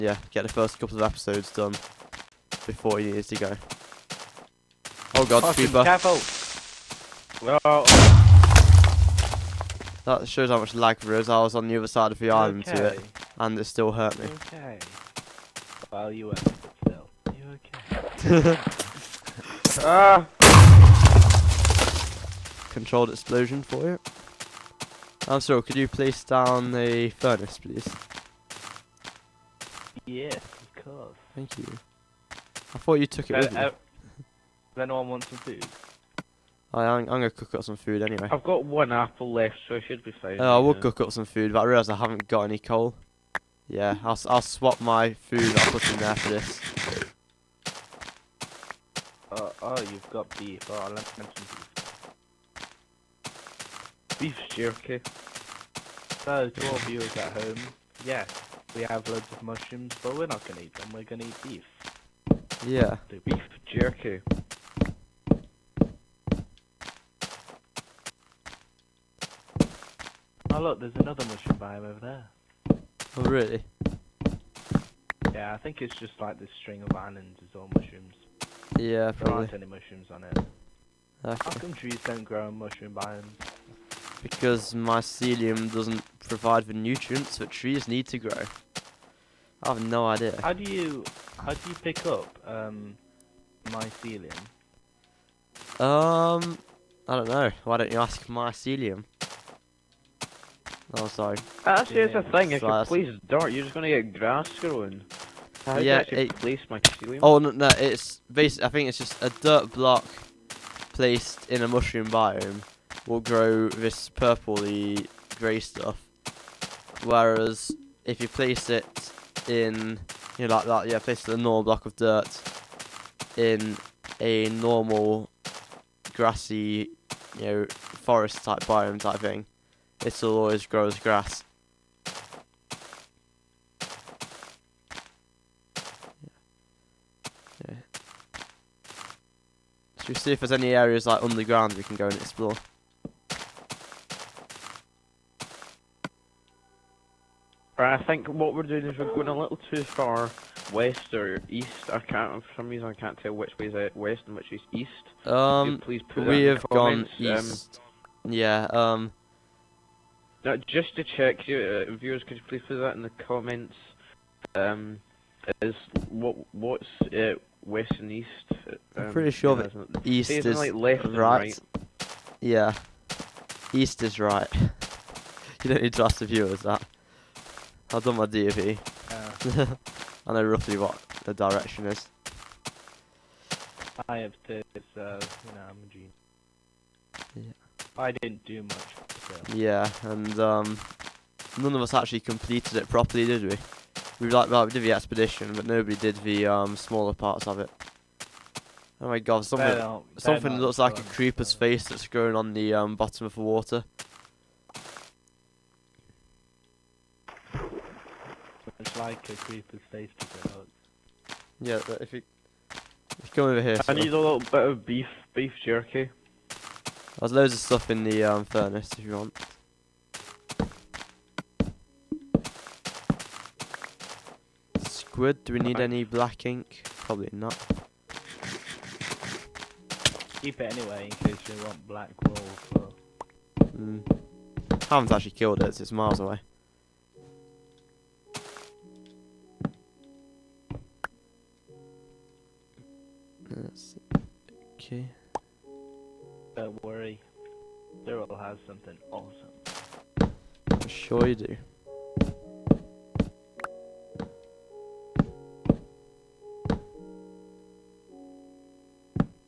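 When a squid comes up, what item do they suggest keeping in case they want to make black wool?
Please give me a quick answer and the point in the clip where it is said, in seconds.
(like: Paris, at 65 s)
black ink, at 226 s.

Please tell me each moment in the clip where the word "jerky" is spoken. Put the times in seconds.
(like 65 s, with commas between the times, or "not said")
54 s, 63 s, 215 s.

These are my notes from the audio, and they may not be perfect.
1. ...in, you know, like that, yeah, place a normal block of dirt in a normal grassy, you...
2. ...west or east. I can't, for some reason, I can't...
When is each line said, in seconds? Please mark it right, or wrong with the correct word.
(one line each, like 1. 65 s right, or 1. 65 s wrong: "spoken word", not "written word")
1. 119 s right
2. 150 s right.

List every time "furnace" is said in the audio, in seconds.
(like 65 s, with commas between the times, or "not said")
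27 s, 218 s.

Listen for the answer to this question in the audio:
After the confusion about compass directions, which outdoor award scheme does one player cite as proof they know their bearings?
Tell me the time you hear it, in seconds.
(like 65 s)
178 s.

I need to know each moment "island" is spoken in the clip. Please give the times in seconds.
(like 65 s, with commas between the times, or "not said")
12 s, 76 s.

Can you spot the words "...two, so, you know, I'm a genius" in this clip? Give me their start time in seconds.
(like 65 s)
184 s.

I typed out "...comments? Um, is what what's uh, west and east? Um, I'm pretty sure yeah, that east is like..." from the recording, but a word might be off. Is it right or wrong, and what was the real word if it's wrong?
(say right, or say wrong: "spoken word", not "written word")
right.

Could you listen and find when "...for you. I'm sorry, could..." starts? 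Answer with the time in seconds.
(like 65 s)
23 s.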